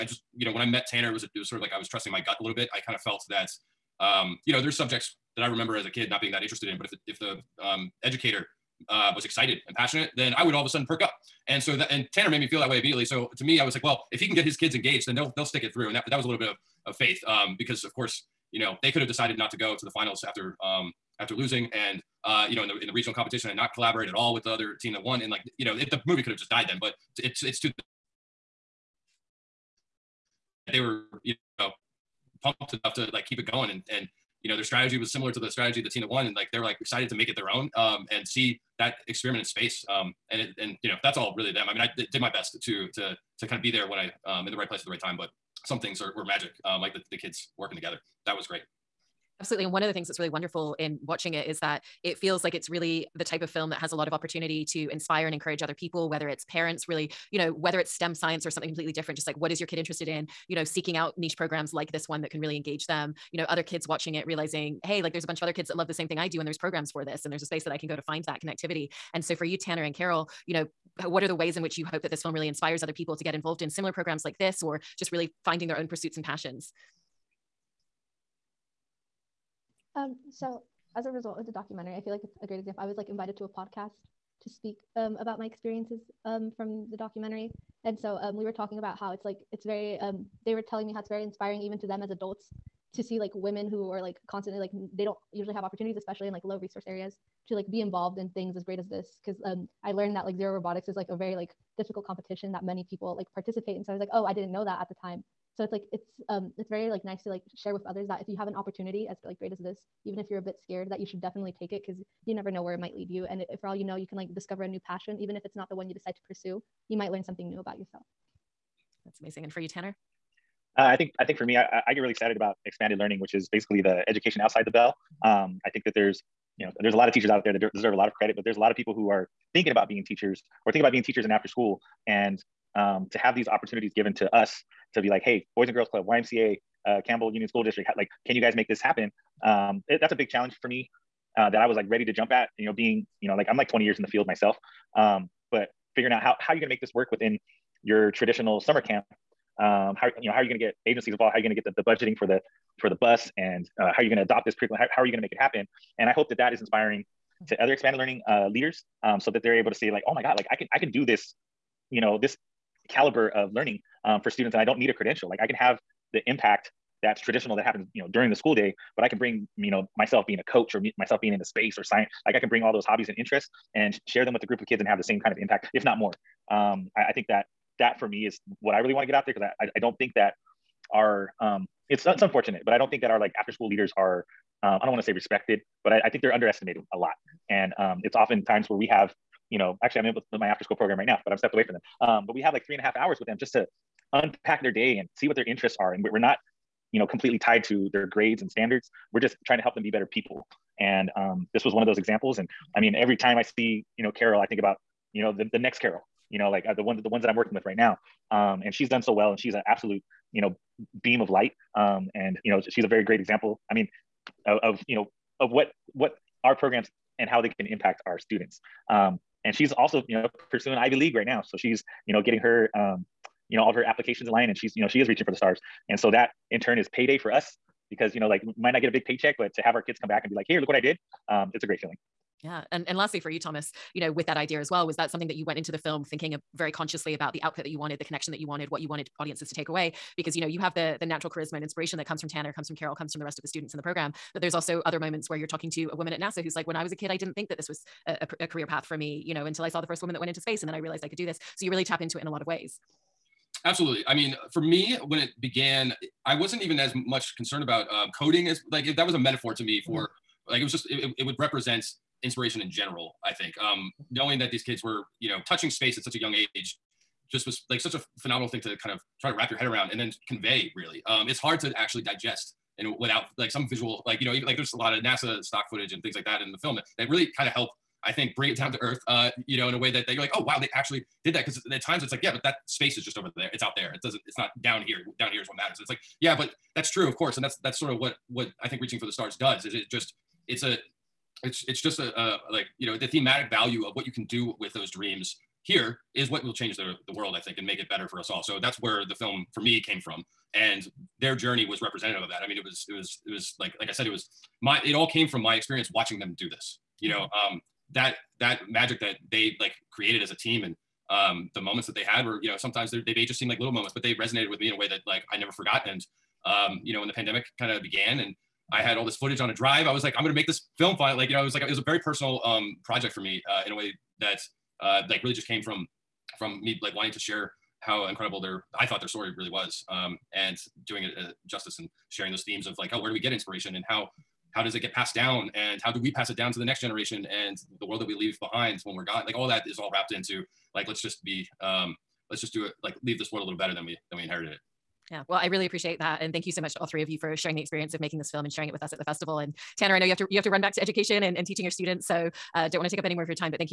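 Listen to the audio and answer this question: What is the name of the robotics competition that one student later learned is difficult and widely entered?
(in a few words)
Zero Robotics.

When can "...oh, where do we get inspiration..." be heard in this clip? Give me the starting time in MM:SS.
05:32.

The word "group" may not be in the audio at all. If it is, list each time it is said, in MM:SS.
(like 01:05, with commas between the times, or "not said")
02:54.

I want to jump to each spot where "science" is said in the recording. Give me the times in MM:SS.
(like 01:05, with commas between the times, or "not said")
00:58, 02:51.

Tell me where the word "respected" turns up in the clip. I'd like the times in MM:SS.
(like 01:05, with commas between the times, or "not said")
03:05.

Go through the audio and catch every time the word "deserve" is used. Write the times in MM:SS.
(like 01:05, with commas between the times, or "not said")
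02:07.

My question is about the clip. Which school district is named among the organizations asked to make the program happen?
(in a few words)
Campbell Union School District.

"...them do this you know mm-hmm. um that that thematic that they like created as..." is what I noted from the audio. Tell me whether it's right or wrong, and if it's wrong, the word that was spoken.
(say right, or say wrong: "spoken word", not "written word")
wrong: "magic", not "thematic".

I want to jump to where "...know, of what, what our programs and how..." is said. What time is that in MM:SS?
03:34.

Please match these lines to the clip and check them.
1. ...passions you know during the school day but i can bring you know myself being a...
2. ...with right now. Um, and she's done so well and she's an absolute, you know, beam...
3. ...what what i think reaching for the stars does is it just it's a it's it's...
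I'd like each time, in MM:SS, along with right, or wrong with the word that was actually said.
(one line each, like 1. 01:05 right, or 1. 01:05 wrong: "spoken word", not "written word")
1. 02:47 wrong: "happens", not "passions"
2. 03:27 right
3. 04:47 right.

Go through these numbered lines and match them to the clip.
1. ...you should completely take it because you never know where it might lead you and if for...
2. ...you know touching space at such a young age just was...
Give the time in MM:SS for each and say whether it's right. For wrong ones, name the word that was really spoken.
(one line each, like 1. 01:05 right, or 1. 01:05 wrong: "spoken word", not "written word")
1. 01:50 wrong: "definitely", not "completely"
2. 04:25 right.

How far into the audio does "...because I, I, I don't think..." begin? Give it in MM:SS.
02:59.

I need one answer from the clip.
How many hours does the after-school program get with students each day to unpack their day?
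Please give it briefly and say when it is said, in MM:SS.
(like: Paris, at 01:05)
3.5, at 03:12.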